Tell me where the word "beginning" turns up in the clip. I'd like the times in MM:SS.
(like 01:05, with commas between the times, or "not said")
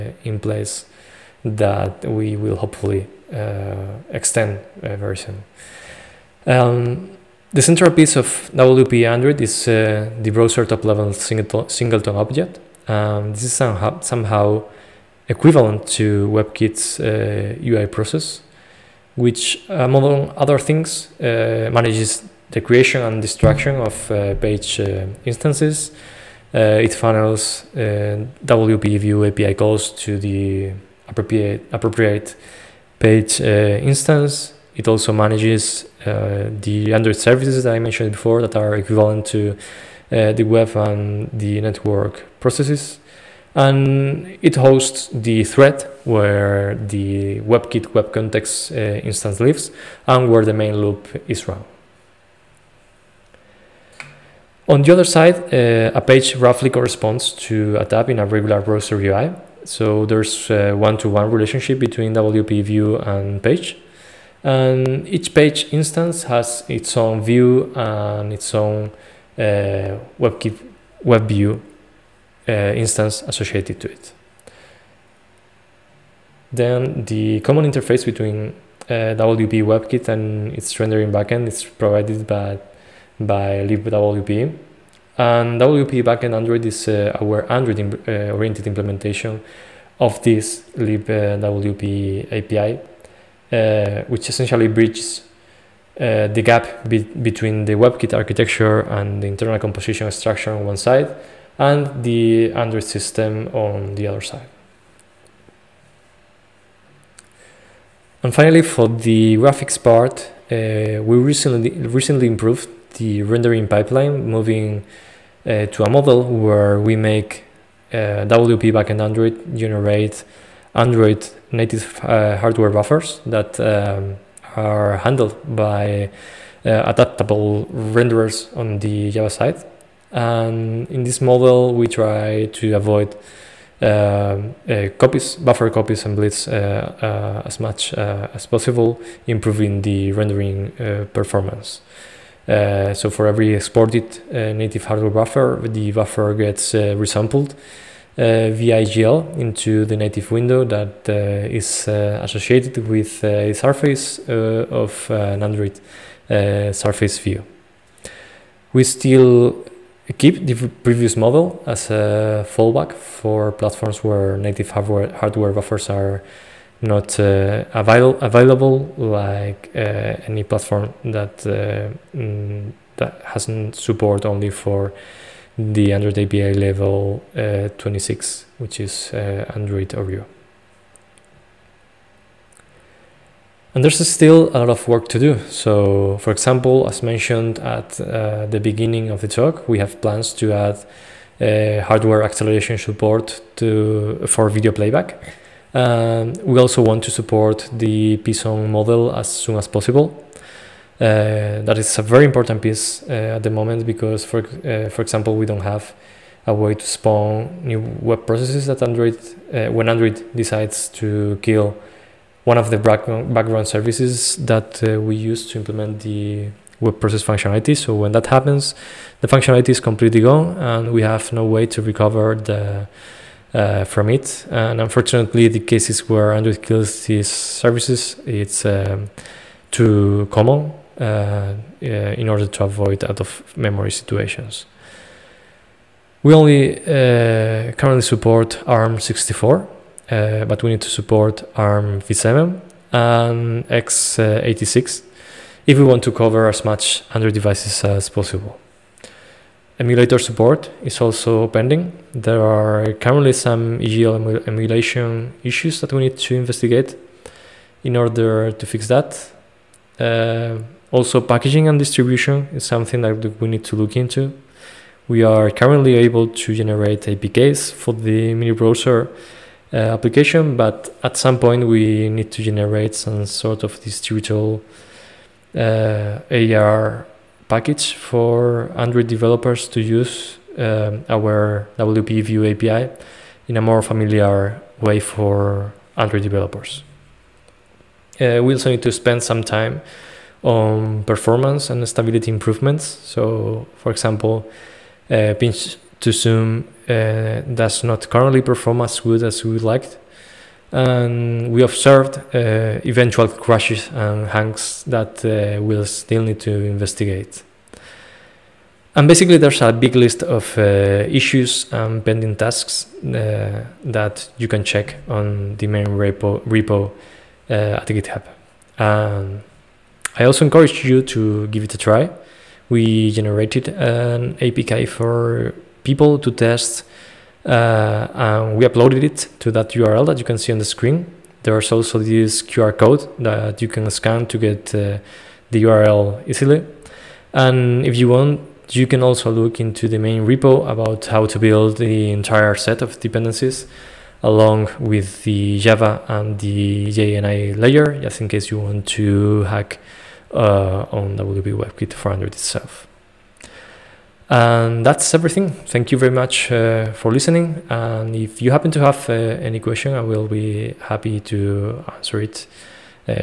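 03:08.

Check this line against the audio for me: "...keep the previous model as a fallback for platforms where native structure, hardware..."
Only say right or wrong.
wrong.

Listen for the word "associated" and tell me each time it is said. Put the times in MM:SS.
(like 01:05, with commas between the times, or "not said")
01:13, 02:31.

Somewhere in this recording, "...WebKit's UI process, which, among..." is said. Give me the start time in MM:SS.
00:16.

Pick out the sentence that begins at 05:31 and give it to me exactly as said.
There's also this QR code that you can scan to get uh, the URL easily.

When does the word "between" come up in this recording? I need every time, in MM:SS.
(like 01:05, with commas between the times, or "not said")
01:01, 01:18, 01:37.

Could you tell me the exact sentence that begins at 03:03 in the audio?
And there's still a lot of work to do.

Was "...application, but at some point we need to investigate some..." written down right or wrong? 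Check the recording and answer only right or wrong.
wrong.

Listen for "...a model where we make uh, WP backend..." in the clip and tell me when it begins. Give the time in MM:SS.
01:55.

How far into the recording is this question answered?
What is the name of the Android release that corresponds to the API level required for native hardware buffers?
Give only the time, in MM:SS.
02:59.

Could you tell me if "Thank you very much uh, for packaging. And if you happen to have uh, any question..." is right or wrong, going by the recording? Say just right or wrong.
wrong.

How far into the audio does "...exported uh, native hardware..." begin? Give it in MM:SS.
02:23.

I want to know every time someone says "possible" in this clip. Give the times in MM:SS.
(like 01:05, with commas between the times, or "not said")
02:18, 03:19, 04:08.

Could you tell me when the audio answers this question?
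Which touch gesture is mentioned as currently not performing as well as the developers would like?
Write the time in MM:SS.
04:55.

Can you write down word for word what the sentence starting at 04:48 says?
Uh, we also need to spend some time on performance and stability improvements.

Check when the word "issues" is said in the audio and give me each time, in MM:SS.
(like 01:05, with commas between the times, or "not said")
04:15, 05:11.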